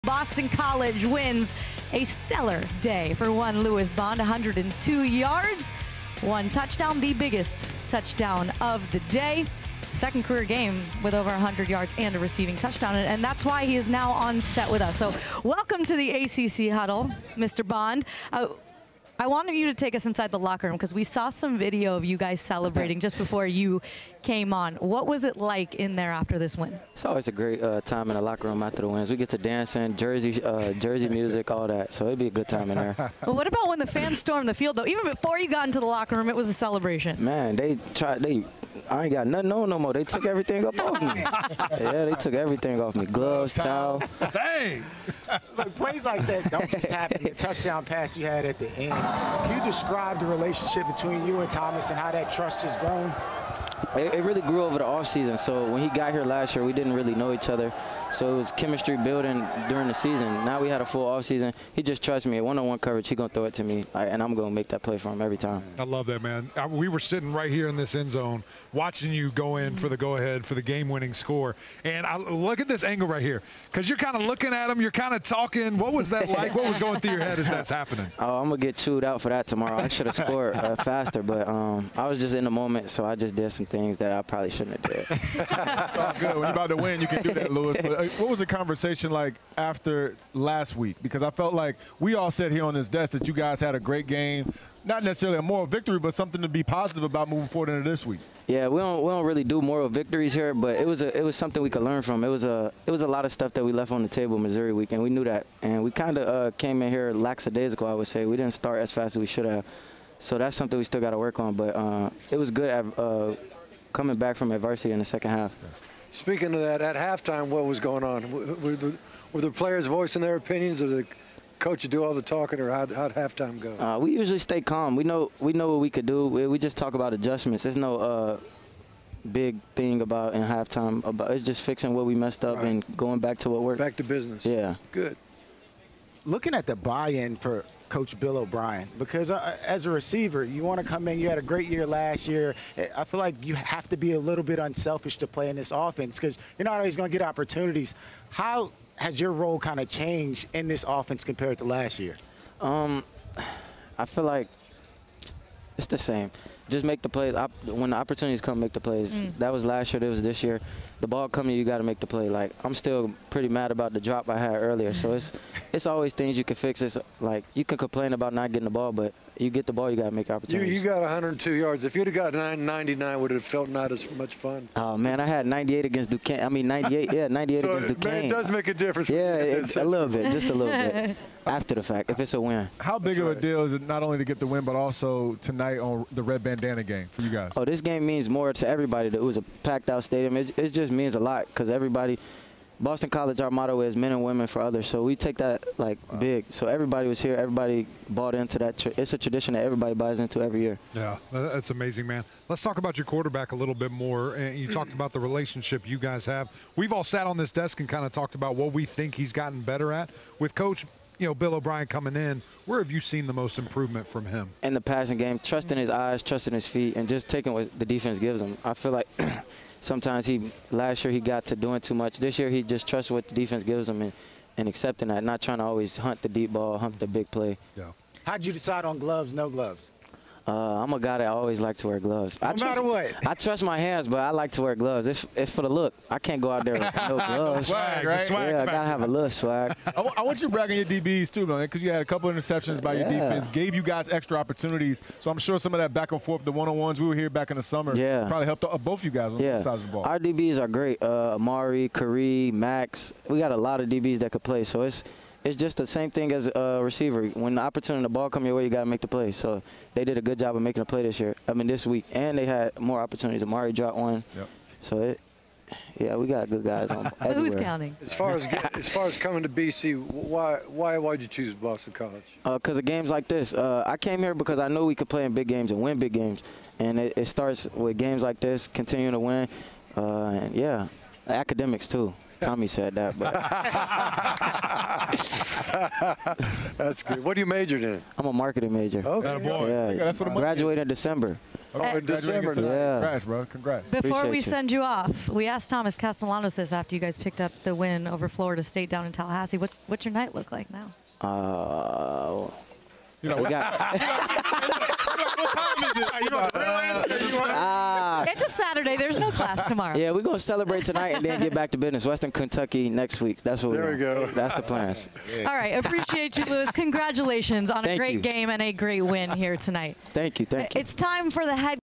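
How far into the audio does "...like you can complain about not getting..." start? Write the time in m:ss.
2:47.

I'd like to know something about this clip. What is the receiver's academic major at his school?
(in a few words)
Marketing.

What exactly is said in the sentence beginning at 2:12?
and going back to what worked.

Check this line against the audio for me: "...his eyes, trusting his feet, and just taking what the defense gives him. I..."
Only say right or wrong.
right.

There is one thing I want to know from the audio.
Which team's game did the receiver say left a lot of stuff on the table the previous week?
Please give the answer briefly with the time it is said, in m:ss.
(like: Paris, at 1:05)
Missouri, at 1:44.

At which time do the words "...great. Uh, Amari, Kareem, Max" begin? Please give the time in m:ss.
4:10.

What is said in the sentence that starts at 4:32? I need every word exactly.
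Because uh, of games like this.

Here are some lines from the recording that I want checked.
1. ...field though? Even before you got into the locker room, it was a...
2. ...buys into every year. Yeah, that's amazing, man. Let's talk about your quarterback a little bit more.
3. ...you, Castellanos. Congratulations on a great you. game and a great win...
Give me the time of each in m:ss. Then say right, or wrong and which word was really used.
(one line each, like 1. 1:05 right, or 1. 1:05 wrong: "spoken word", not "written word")
1. 0:34 right
2. 3:19 right
3. 5:16 wrong: "Lewis", not "Castellanos".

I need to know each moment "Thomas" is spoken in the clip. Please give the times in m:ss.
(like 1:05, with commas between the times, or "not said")
0:51, 4:55.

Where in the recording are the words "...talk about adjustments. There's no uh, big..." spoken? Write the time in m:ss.
2:06.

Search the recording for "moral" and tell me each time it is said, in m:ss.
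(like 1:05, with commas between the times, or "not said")
1:35, 1:39.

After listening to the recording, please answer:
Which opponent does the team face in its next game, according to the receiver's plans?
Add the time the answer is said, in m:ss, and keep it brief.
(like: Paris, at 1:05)
Western Kentucky, at 5:12.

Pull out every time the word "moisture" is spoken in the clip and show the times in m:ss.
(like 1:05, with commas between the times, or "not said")
not said.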